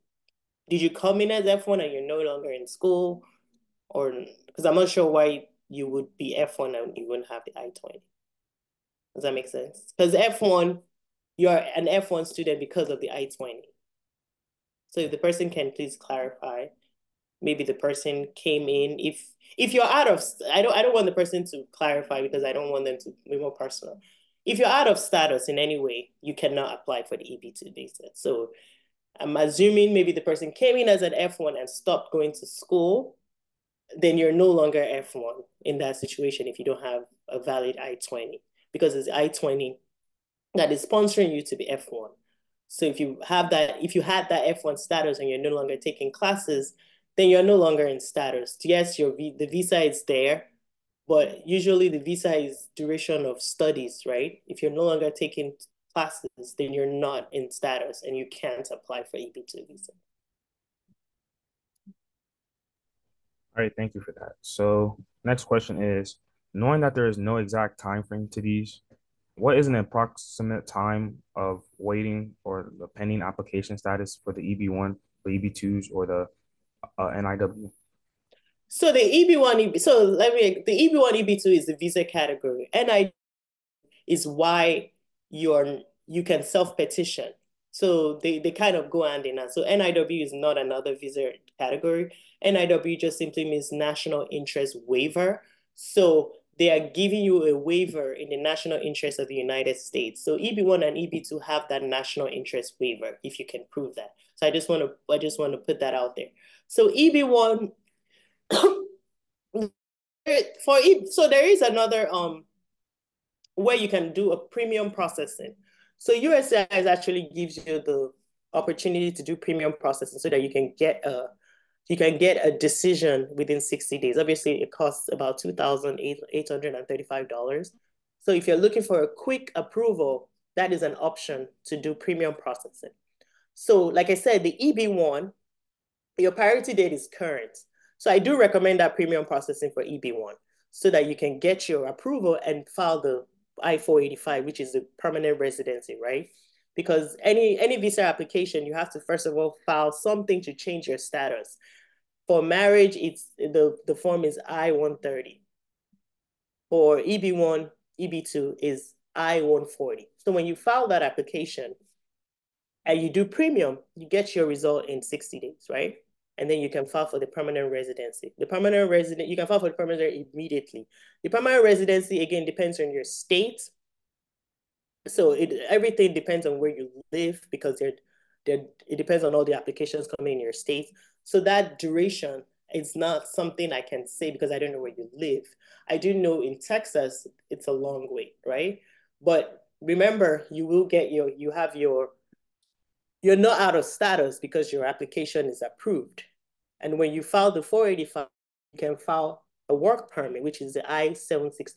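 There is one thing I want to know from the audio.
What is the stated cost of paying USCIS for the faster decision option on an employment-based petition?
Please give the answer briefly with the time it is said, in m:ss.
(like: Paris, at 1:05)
$2,835, at 2:05.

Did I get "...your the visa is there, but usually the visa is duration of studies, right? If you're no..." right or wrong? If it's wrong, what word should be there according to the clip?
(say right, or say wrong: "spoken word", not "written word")
right.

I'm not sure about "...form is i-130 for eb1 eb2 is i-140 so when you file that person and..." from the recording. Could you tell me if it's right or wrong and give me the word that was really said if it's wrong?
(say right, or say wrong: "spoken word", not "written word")
wrong: "application", not "person".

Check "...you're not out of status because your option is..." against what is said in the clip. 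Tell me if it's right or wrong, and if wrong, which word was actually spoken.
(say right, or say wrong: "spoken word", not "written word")
wrong: "application", not "option".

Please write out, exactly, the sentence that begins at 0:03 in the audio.
Or, because I'm not sure why you would be F1 and you wouldn't have the I-20.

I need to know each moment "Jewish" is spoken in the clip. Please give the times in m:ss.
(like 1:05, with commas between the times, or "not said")
not said.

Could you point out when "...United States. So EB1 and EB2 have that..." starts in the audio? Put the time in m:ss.
1:39.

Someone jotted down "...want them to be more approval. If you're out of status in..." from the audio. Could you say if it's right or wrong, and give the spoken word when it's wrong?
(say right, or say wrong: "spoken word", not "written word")
wrong: "personal", not "approval".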